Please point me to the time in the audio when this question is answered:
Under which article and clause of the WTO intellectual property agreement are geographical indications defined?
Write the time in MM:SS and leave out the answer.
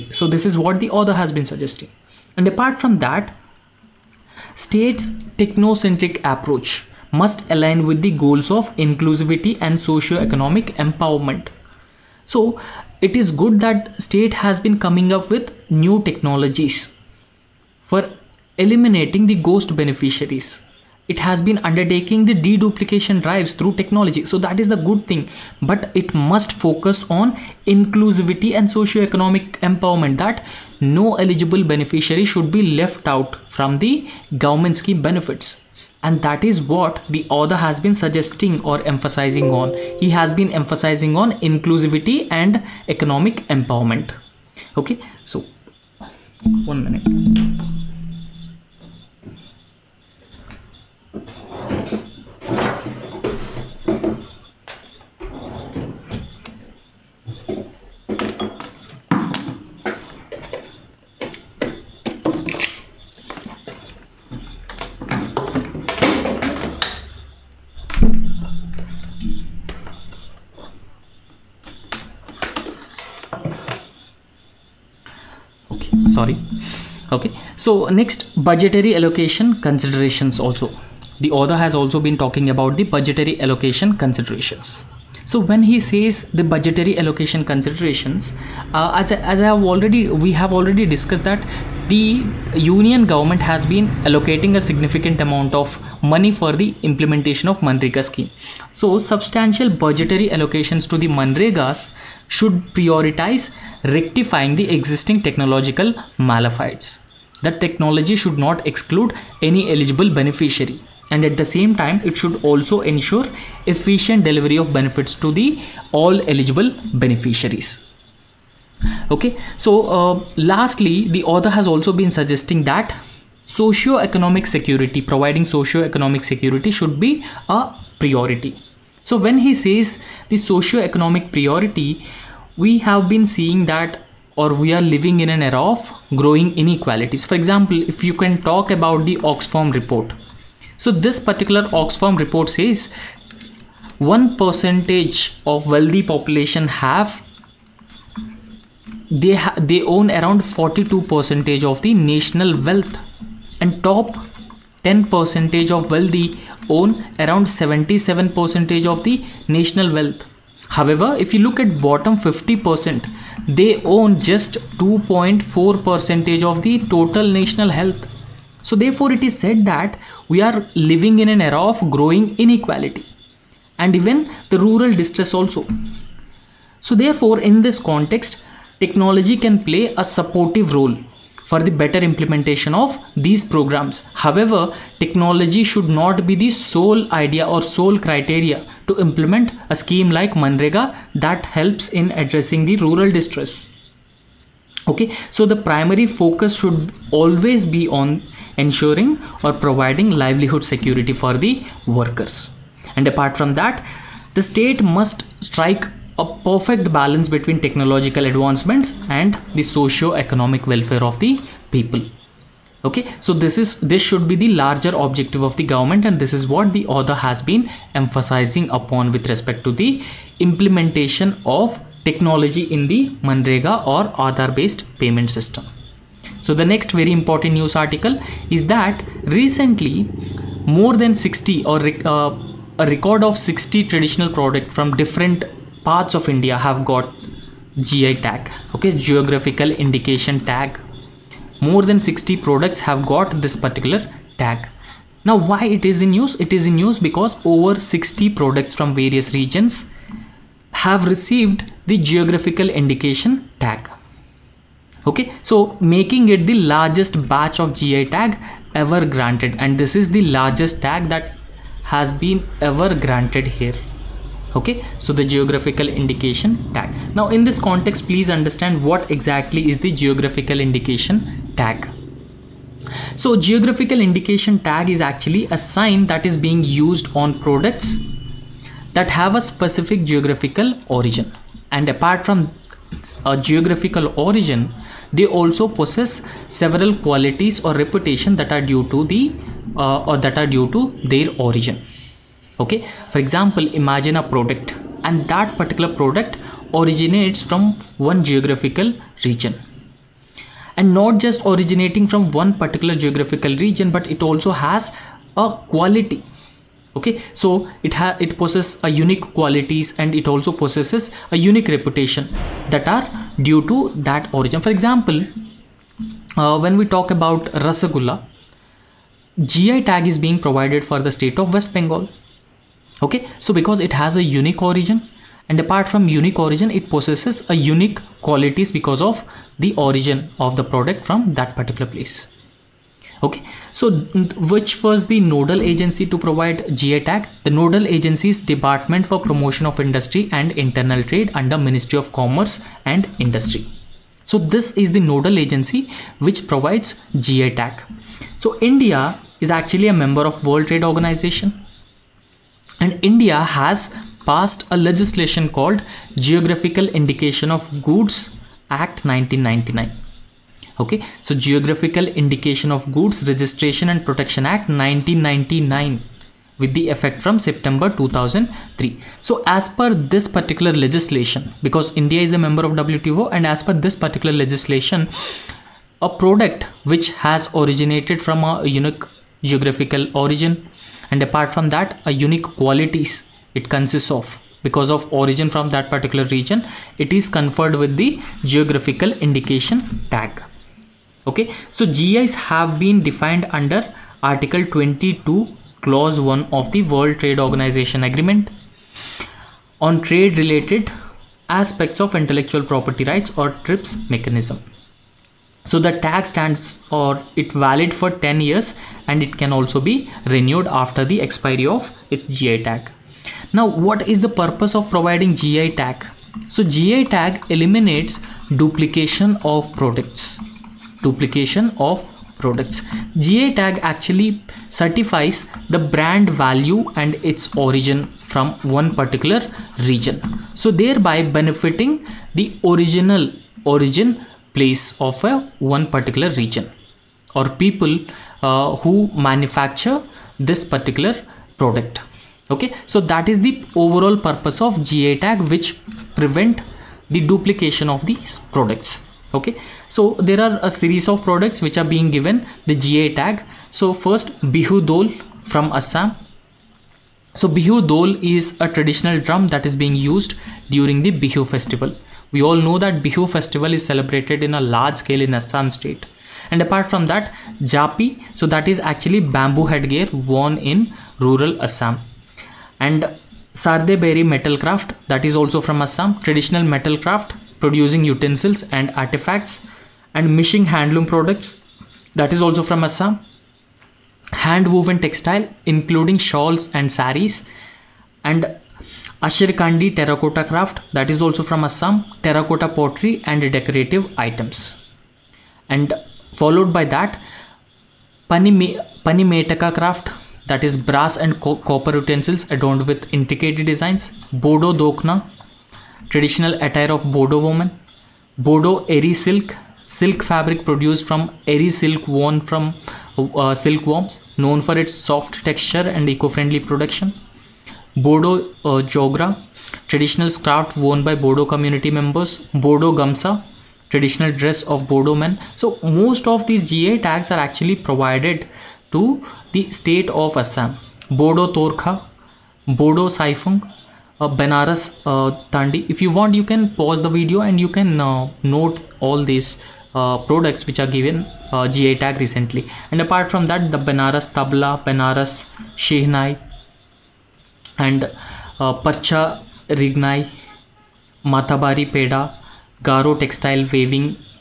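06:34.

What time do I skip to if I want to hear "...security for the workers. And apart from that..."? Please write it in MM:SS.
03:20.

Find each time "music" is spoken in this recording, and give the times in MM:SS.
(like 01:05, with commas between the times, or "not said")
not said.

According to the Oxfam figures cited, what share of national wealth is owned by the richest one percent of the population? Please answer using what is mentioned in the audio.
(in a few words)
42%.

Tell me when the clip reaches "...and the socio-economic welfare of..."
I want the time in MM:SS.
03:29.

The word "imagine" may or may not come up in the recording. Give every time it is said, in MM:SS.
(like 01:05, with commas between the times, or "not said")
04:53.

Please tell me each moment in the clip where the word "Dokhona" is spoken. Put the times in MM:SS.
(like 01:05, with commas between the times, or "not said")
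08:24.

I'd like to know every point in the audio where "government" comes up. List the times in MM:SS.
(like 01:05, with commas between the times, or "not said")
00:34, 01:33, 03:35.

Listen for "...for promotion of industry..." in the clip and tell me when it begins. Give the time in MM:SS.
05:39.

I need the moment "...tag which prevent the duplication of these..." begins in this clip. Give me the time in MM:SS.
07:25.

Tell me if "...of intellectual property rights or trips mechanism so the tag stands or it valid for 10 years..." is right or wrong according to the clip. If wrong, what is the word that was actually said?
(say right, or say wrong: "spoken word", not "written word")
right.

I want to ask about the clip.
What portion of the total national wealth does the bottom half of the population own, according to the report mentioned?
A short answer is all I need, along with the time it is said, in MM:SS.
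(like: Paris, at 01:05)
2.4%, at 02:44.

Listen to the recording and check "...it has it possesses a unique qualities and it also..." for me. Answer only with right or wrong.
right.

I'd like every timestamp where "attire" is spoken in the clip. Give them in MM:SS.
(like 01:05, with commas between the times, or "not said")
08:26.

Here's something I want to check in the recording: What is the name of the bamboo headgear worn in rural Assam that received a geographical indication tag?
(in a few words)
Jaapi.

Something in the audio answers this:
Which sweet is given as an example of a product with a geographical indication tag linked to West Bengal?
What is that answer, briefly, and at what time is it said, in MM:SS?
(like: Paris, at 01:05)
Rasagulla, at 05:17.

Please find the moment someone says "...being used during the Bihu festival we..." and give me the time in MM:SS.
07:39.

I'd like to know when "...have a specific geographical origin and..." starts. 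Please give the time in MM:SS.
04:39.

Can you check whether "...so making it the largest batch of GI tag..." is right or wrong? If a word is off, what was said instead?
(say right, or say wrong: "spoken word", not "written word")
right.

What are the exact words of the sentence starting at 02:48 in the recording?
So therefore it is said that we are living in an era of growing inequality and even the rural distress also.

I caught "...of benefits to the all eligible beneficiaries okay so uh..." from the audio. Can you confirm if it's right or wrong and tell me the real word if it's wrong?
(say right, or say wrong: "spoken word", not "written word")
right.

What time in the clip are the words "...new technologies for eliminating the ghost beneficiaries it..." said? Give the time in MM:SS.
00:15.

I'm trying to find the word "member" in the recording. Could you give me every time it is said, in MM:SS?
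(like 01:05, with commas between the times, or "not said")
05:50, 06:12, 08:41.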